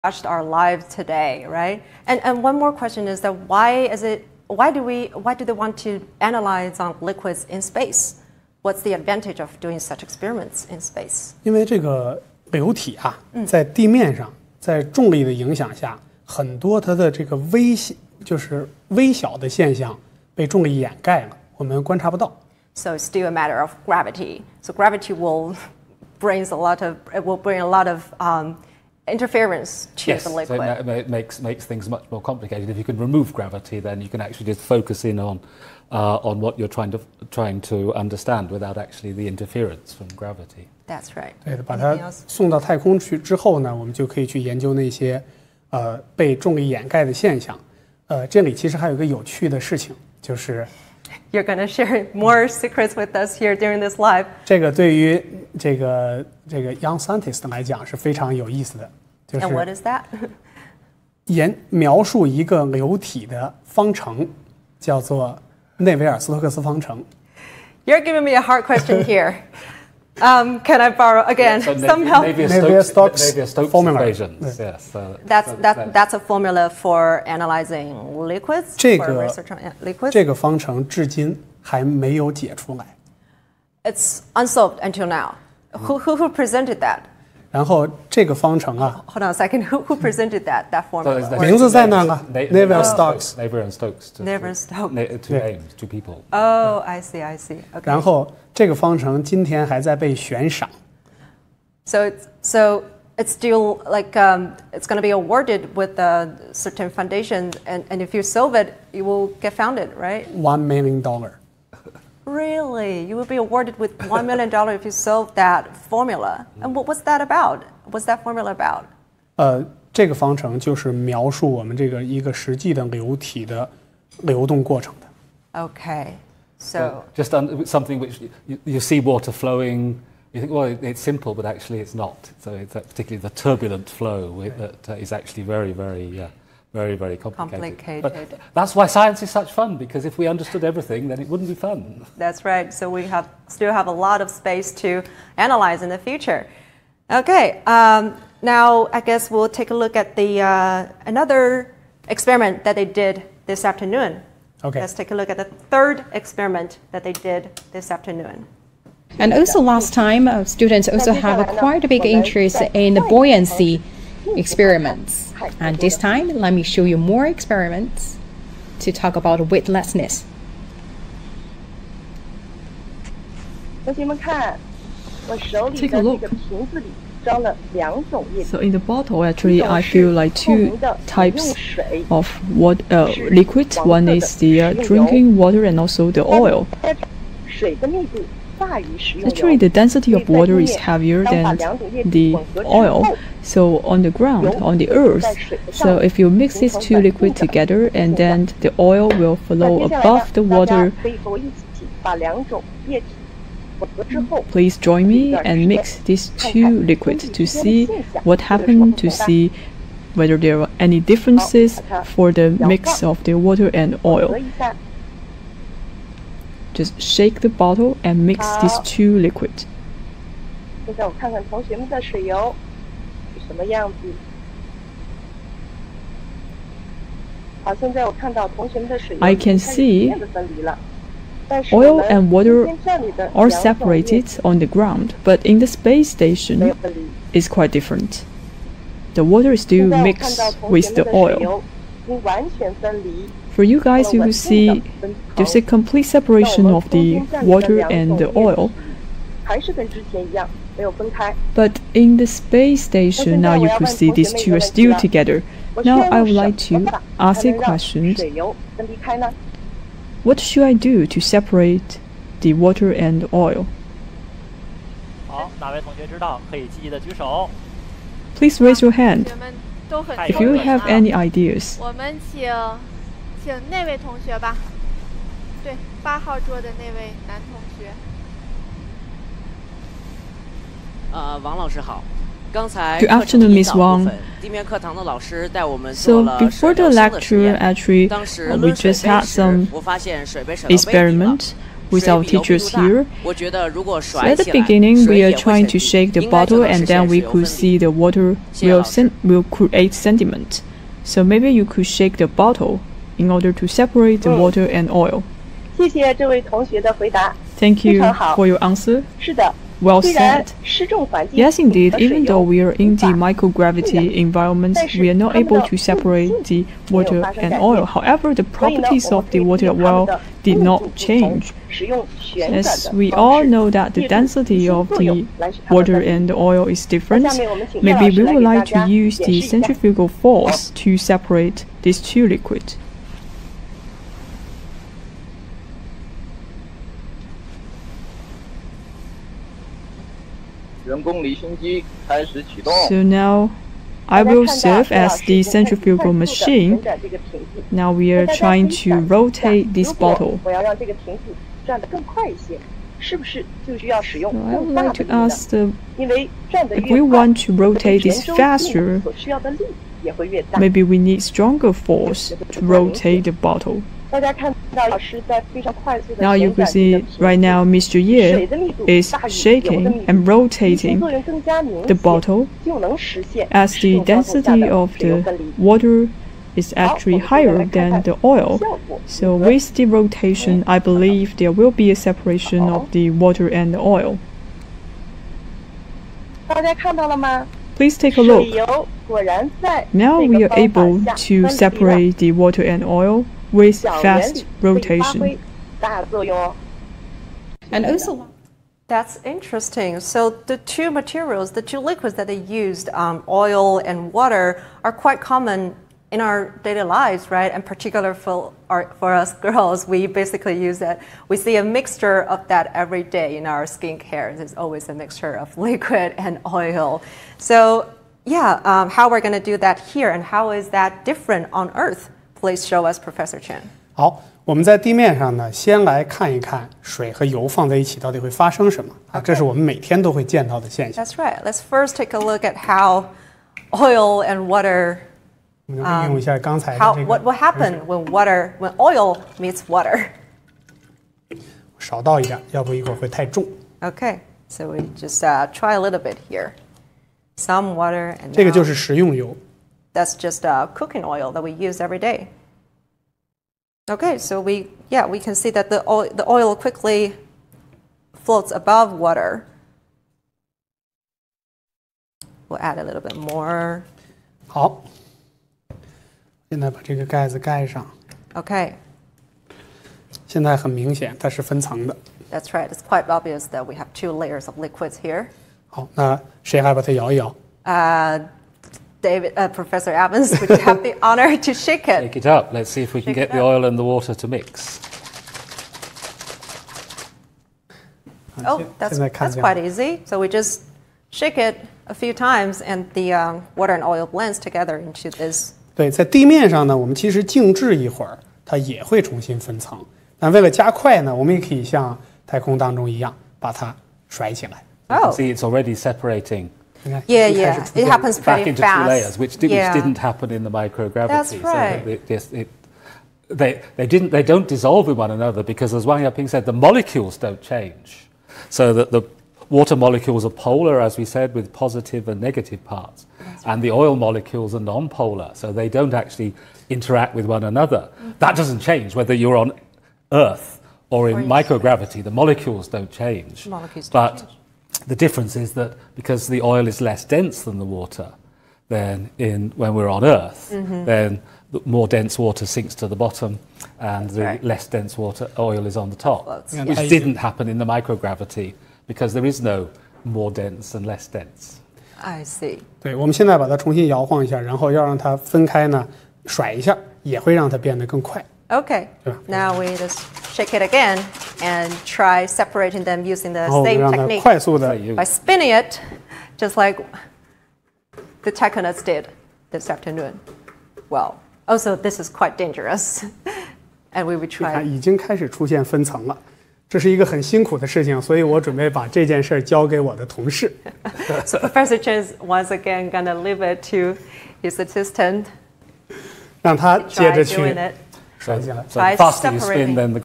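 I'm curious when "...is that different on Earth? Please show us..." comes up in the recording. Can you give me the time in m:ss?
7:00.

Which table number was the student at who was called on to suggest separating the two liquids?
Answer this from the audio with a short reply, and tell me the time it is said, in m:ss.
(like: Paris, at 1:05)
8, at 4:36.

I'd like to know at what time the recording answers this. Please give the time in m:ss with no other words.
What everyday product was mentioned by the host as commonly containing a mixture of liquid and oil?
6:53.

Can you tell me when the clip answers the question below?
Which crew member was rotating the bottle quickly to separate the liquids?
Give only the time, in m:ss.
6:07.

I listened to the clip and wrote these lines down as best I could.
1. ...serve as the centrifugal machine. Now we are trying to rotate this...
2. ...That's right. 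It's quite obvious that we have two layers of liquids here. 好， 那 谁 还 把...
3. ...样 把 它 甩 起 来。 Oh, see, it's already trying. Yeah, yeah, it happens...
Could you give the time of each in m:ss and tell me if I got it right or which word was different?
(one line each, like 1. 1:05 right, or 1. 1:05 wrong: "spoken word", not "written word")
1. 5:44 right
2. 7:52 right
3. 8:22 wrong: "separating", not "trying".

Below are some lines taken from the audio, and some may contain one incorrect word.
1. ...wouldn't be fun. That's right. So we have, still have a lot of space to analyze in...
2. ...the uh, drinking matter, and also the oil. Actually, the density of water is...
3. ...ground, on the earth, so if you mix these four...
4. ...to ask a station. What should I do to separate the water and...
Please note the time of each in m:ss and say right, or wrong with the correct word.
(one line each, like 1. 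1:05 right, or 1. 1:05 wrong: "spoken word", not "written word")
1. 2:21 right
2. 3:04 wrong: "water", not "matter"
3. 3:14 wrong: "two", not "four"
4. 4:16 wrong: "question", not "station".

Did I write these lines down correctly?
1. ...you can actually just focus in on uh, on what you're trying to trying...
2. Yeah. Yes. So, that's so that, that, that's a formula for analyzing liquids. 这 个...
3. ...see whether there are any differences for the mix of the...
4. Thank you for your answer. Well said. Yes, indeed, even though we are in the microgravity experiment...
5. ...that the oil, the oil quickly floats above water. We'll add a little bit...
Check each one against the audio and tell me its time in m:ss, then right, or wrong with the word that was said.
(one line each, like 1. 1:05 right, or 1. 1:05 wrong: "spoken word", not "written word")
1. 0:34 right
2. 1:14 right
3. 3:29 right
4. 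5:05 wrong: "environment", not "experiment"
5. 7:35 right.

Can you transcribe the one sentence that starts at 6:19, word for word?
So with the rotation, I believe there will be a separation of the water and the oil.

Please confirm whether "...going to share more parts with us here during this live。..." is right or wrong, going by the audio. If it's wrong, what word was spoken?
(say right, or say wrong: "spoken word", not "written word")
wrong: "secrets", not "parts".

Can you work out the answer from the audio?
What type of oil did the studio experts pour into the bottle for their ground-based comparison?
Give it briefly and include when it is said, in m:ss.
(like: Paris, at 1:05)
Cooking oil, at 7:30.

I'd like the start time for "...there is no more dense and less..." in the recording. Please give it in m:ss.
9:09.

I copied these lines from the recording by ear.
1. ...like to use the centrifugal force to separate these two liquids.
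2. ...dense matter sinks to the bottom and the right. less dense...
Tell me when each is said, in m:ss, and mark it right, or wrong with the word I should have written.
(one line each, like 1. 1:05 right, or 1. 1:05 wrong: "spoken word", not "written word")
1. 5:28 right
2. 9:01 wrong: "water", not "matter".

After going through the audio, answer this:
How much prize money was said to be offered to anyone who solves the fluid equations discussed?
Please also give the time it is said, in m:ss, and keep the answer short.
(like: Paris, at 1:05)
$1 million, at 1:50.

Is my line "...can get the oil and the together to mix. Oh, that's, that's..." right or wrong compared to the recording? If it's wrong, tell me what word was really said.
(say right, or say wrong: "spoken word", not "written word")
wrong: "water", not "together".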